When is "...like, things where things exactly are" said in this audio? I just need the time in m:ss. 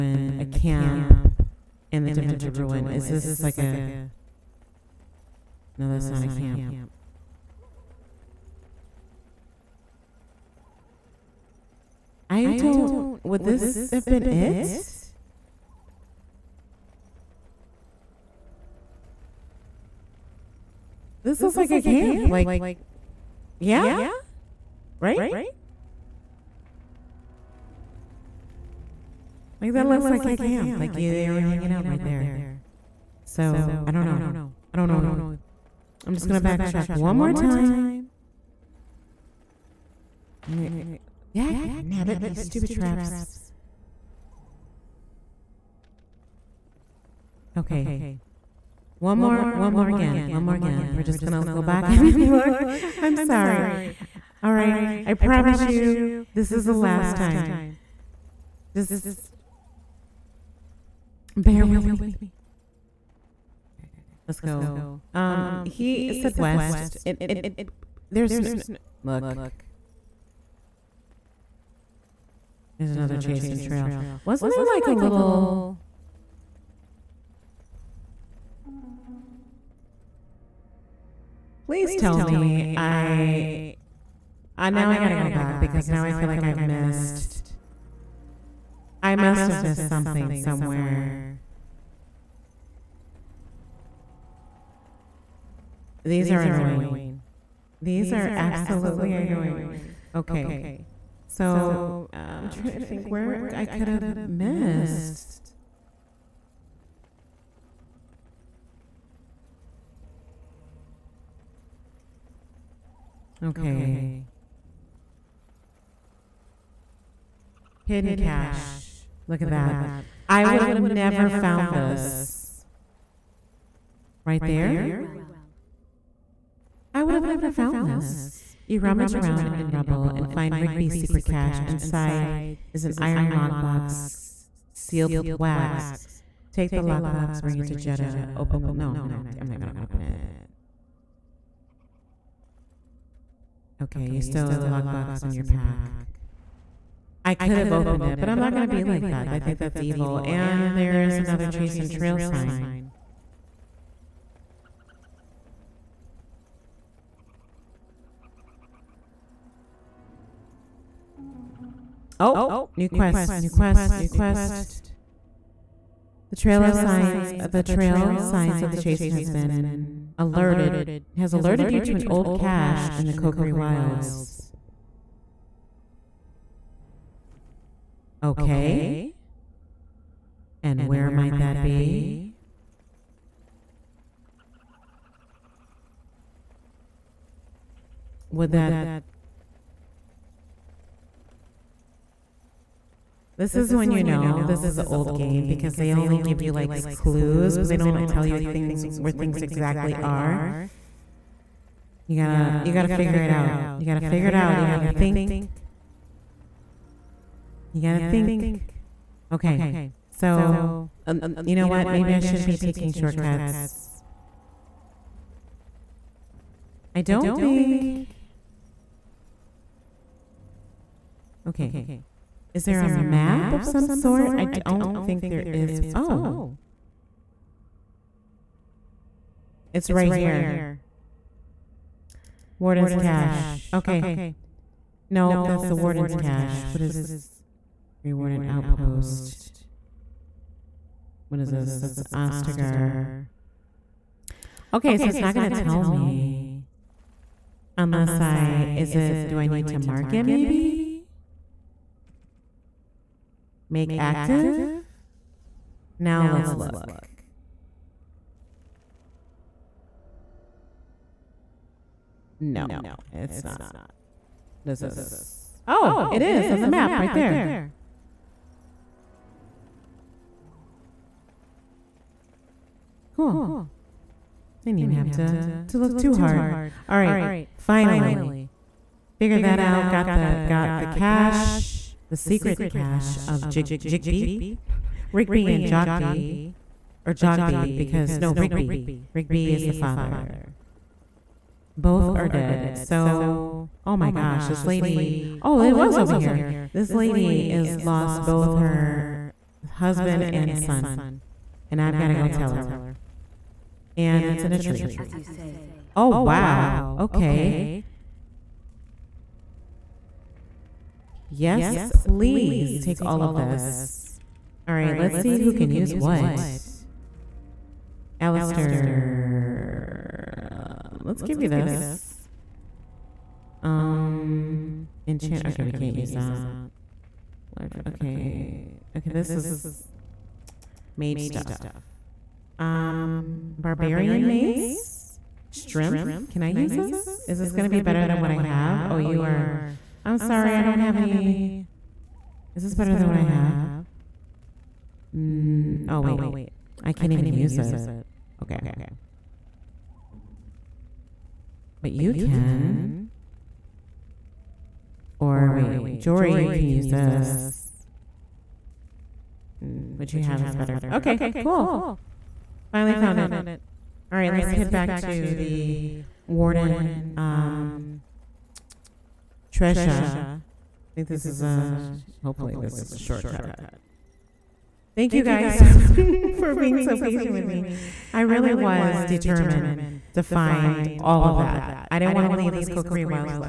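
3:18.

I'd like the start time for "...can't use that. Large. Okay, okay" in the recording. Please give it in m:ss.
5:25.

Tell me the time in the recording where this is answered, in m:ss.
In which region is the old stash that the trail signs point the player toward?
2:53.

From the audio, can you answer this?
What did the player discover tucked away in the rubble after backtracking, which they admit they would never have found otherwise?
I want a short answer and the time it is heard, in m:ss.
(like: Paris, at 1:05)
Hidden cache, at 1:57.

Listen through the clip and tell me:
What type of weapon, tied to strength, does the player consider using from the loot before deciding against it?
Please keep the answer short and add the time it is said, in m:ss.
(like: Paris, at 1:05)
barbarian mace, at 5:33.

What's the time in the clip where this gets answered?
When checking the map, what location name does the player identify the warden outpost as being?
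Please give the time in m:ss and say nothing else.
4:02.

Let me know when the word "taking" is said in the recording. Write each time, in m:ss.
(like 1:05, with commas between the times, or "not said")
3:32.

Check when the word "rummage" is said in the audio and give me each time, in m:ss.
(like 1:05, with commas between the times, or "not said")
2:08.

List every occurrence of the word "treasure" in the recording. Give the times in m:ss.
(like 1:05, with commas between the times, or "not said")
6:09.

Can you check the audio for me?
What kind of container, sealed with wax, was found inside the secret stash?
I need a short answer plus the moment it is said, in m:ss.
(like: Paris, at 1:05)
iron lockbox, at 2:12.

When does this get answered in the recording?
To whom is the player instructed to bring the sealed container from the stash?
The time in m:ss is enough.
2:17.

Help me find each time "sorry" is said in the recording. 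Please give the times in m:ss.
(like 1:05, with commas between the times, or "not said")
0:53, 5:40.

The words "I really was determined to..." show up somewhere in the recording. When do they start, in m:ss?
6:18.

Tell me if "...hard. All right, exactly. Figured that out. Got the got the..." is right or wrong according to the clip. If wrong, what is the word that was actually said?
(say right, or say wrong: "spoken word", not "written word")
wrong: "finally", not "exactly".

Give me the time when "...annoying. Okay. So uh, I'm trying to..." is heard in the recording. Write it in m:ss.
1:39.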